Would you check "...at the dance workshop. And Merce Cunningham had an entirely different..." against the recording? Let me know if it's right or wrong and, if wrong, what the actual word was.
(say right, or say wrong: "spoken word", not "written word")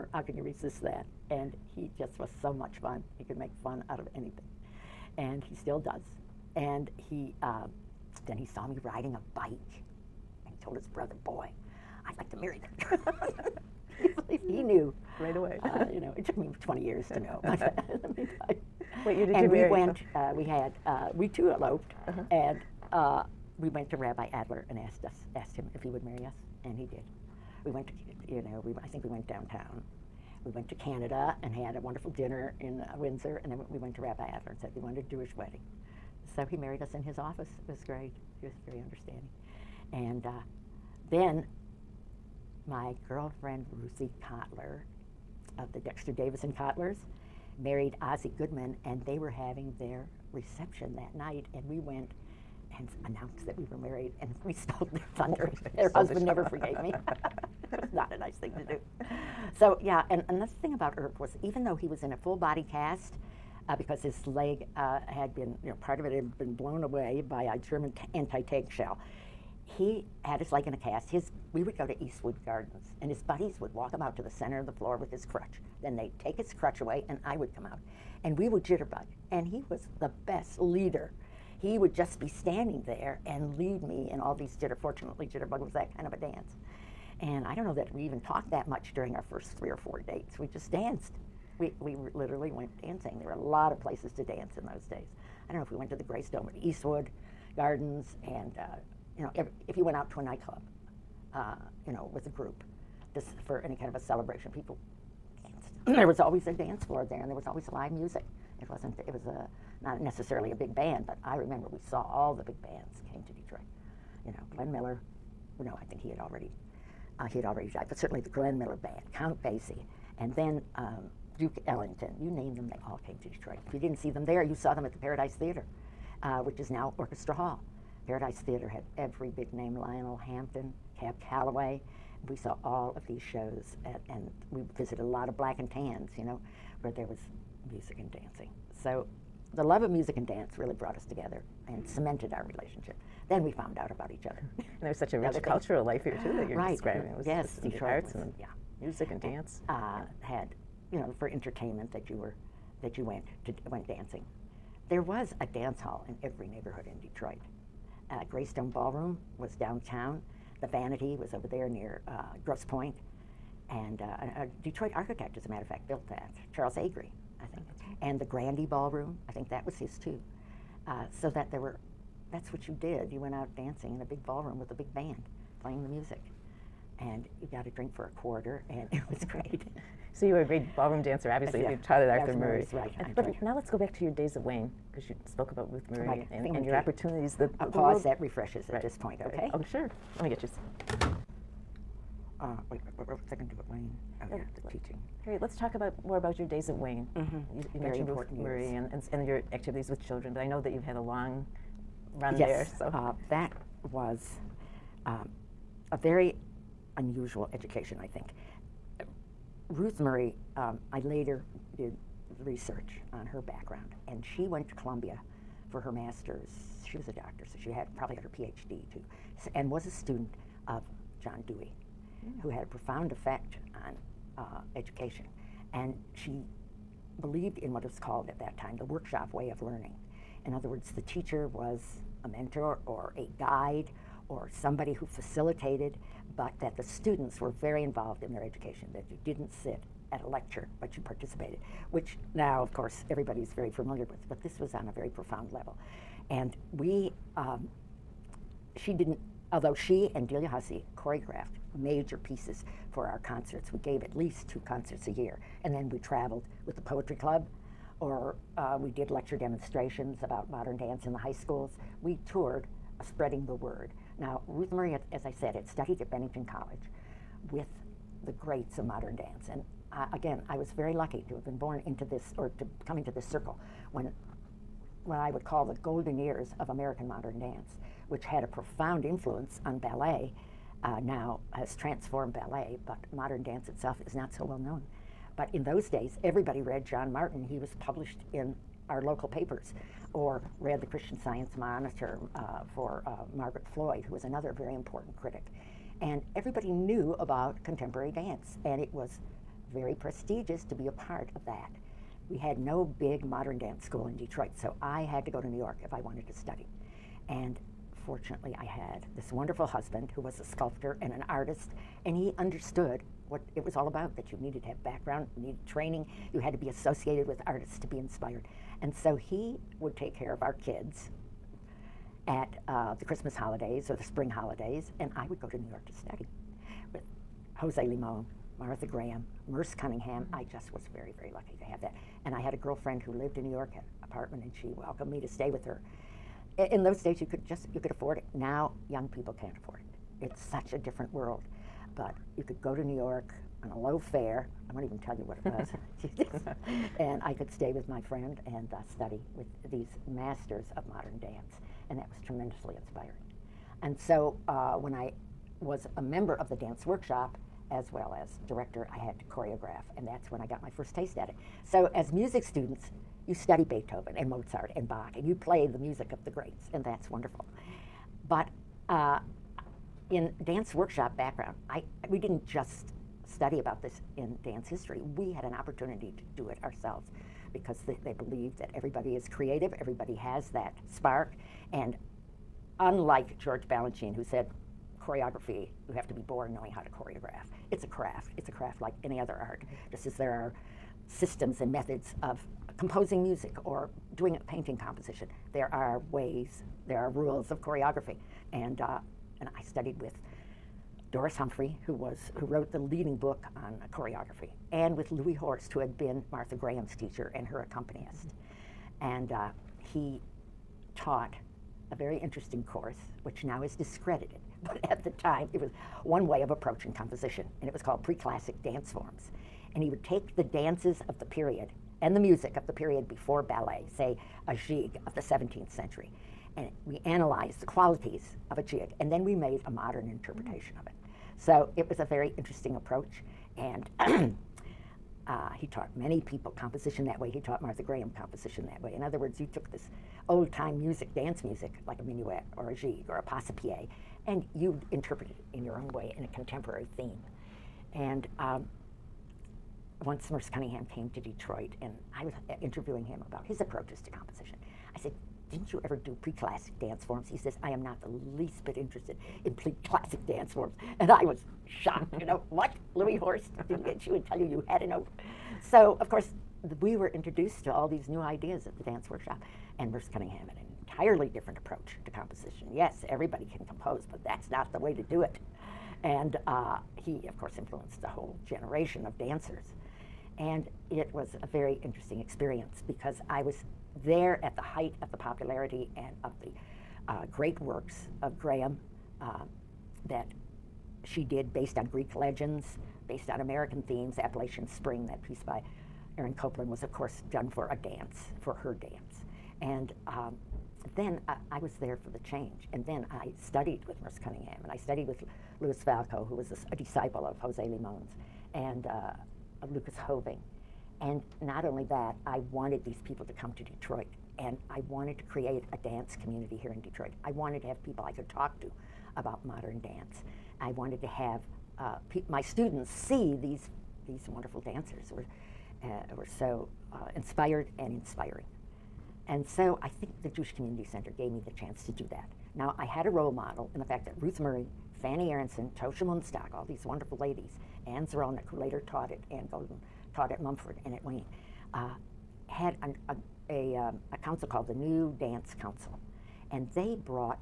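right.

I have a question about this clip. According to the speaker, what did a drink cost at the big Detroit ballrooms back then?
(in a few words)
a quarter.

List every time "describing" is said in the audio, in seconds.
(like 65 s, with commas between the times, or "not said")
146 s.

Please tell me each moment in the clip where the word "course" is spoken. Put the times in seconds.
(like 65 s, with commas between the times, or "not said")
242 s, 412 s, 466 s, 477 s, 496 s.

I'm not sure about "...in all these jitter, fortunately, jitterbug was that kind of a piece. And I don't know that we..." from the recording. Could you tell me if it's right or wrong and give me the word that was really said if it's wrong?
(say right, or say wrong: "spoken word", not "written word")
wrong: "dance", not "piece".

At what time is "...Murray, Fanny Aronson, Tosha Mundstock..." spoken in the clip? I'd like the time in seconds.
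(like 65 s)
534 s.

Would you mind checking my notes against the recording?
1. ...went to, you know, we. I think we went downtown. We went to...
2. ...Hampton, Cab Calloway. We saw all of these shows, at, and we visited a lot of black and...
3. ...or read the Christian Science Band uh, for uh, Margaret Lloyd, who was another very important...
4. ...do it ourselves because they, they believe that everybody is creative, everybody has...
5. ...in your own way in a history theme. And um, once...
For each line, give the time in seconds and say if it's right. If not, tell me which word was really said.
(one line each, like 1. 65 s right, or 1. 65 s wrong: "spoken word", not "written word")
1. 27 s right
2. 130 s right
3. 290 s wrong: "Monitor", not "Band"
4. 376 s right
5. 445 s wrong: "contemporary", not "history".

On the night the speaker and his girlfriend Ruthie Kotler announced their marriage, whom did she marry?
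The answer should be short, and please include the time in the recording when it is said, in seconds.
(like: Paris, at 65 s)
Ozzie Goodman, at 48 s.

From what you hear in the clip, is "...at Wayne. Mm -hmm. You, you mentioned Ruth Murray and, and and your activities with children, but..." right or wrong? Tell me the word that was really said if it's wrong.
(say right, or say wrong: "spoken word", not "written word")
right.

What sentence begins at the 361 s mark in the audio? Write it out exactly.
So, as music students, you study Beethoven and Mozart and Bach, and you play the music of the greats, and that's wonderful.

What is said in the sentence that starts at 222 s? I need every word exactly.
who had a profound effect on uh, education.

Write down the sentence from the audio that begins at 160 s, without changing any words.
The Vanity was over there near uh, Grosse Pointe.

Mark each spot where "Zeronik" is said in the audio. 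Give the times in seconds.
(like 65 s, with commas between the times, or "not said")
538 s.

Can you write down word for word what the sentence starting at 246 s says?
And we um, she didn't, although she and Delia Hussey choreographed major pieces for our concerts.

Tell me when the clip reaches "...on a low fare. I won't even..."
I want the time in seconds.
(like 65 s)
343 s.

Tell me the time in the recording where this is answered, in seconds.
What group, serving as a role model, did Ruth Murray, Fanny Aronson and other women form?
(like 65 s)
544 s.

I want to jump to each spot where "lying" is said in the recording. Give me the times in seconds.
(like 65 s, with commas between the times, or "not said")
not said.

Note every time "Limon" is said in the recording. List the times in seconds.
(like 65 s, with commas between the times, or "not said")
327 s, 507 s.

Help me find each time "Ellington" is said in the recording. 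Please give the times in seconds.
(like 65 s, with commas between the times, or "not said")
121 s.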